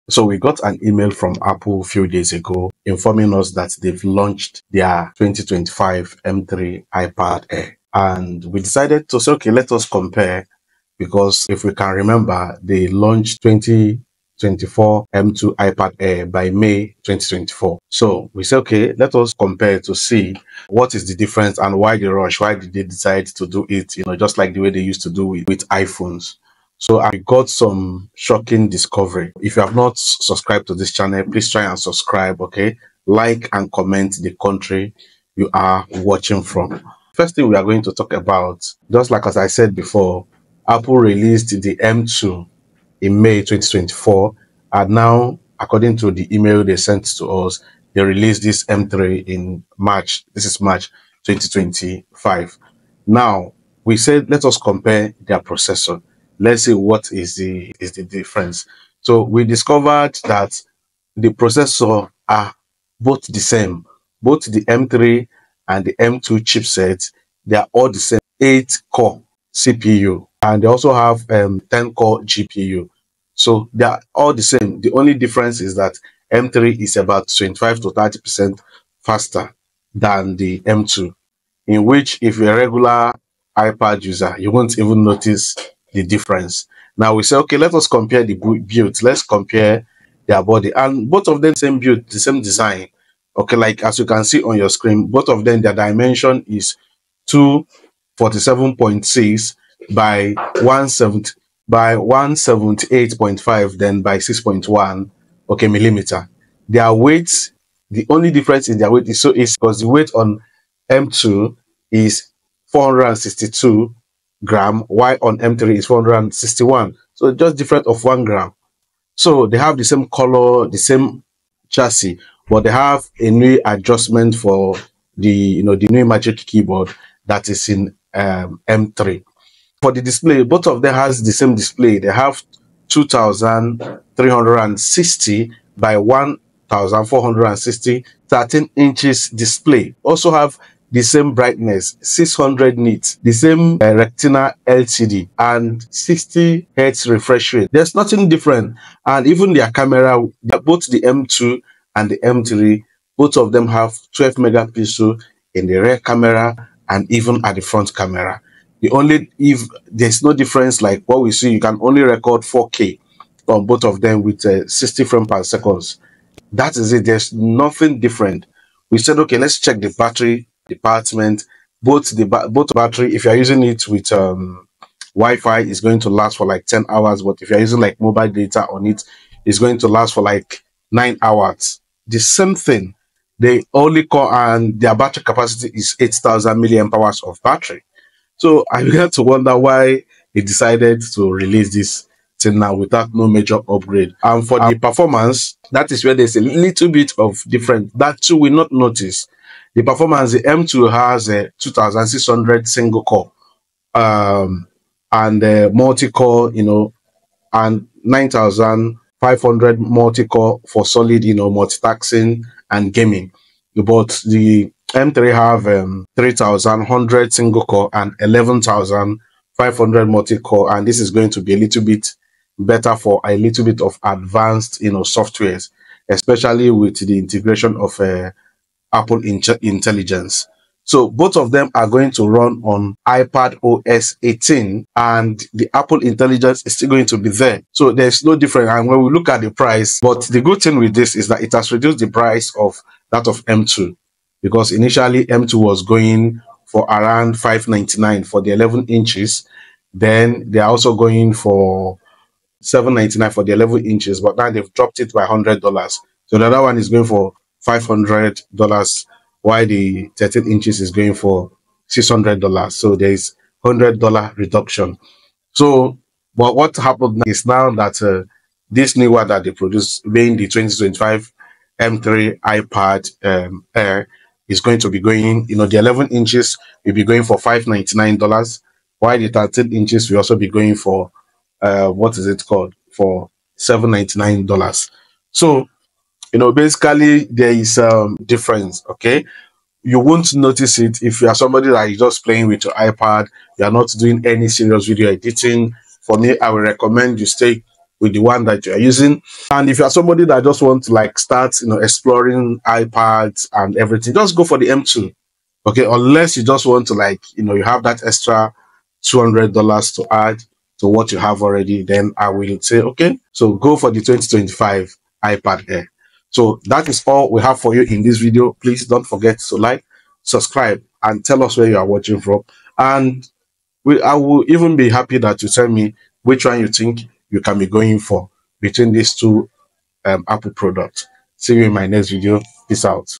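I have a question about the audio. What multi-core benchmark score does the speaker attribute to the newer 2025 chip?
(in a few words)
11,500.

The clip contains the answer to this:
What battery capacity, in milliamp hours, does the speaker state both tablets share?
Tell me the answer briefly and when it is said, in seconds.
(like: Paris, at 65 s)
8,000 mAh, at 185 s.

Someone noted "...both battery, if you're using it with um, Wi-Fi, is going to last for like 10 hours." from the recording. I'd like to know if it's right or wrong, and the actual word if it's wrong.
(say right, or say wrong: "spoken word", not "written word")
right.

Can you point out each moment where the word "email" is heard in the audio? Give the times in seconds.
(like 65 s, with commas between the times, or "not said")
0 s, 46 s.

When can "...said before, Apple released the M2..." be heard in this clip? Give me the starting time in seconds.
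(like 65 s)
39 s.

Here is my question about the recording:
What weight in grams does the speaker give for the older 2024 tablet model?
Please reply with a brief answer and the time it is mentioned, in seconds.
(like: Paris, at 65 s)
462 grams, at 112 s.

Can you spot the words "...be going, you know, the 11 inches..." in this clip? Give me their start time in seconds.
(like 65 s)
274 s.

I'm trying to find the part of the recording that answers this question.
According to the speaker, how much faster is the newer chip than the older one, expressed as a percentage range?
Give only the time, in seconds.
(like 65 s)
77 s.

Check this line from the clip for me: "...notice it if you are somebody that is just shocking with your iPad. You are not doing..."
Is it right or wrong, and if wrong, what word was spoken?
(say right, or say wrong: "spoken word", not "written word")
wrong: "playing", not "shocking".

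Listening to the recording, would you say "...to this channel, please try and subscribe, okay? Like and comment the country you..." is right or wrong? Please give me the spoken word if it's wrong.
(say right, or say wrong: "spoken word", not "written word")
right.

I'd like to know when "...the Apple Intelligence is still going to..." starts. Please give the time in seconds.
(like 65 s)
235 s.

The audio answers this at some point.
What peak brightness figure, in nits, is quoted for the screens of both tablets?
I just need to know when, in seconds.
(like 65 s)
142 s.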